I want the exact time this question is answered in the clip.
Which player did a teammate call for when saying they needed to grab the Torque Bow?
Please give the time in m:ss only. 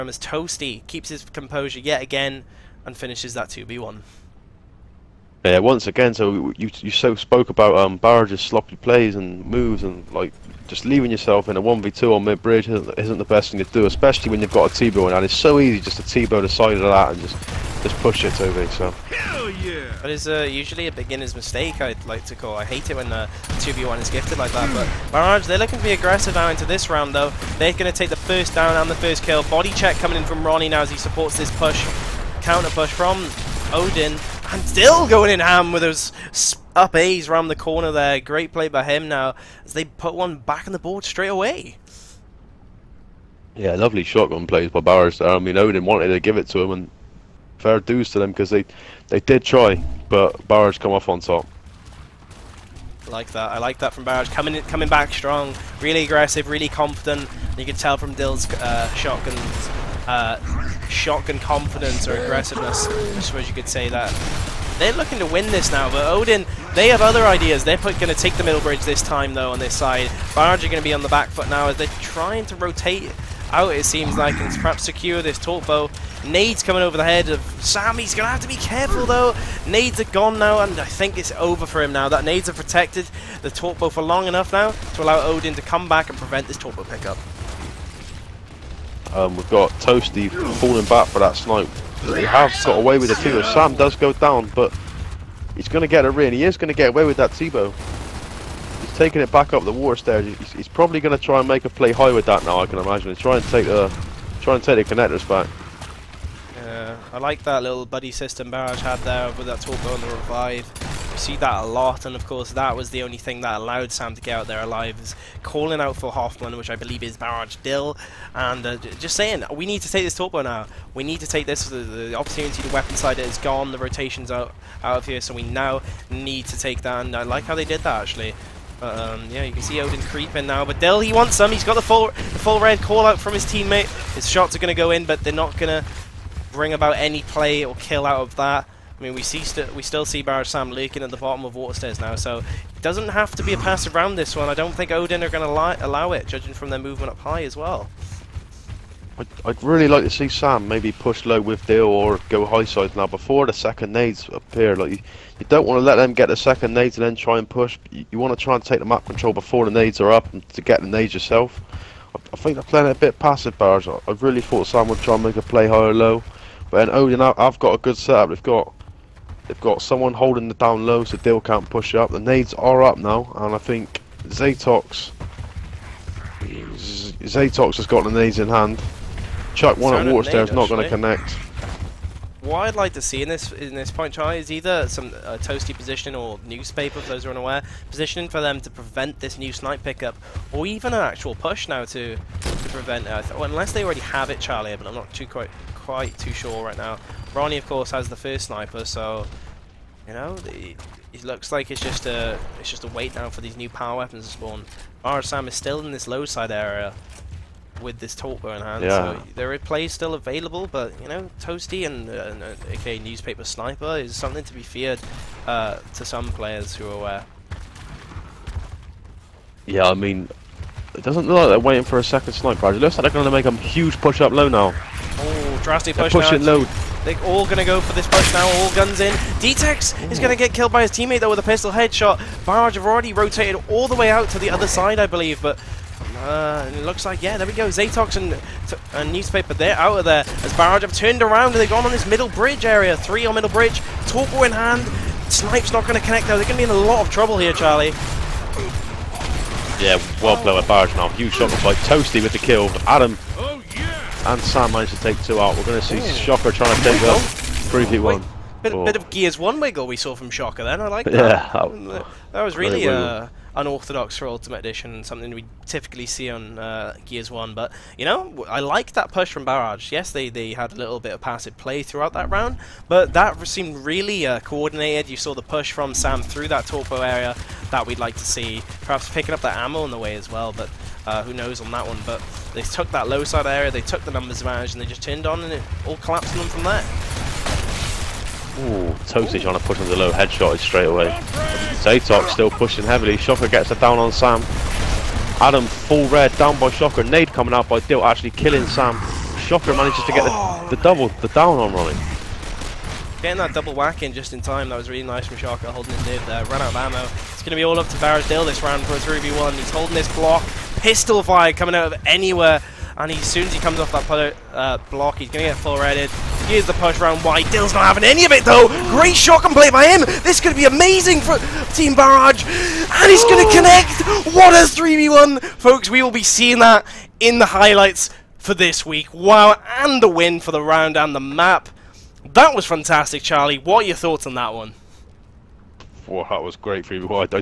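1:56.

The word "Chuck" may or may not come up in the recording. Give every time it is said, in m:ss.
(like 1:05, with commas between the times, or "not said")
2:59.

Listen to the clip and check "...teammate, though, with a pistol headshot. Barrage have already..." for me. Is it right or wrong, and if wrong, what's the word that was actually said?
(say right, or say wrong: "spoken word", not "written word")
right.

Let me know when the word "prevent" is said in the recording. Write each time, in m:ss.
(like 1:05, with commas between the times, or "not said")
1:26, 3:08, 3:12.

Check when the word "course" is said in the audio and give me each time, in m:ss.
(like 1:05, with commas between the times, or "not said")
1:52, 3:17.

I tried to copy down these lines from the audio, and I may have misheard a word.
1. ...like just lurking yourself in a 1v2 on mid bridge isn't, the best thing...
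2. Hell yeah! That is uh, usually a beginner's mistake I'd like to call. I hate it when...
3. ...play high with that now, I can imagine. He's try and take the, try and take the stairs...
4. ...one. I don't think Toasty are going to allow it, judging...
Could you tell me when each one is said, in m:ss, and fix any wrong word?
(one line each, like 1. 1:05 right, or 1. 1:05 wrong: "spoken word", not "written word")
1. 0:10 wrong: "leaving", not "lurking"
2. 0:19 right
3. 1:41 wrong: "connectors", not "stairs"
4. 2:24 wrong: "Odin", not "Toasty".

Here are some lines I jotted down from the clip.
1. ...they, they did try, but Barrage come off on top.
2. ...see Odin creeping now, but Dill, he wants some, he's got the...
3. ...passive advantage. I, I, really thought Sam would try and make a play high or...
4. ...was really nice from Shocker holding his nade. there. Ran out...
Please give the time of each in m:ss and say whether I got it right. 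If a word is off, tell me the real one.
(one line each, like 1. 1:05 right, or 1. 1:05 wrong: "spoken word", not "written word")
1. 0:48 right
2. 2:09 right
3. 2:43 wrong: "barrage", not "advantage"
4. 5:04 right.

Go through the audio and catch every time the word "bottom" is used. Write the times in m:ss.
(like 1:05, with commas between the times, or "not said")
2:21.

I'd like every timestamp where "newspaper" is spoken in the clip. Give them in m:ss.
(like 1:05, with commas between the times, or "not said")
3:06, 3:33, 3:59.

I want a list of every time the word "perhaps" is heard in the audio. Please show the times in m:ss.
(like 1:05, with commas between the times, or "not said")
1:14, 4:38.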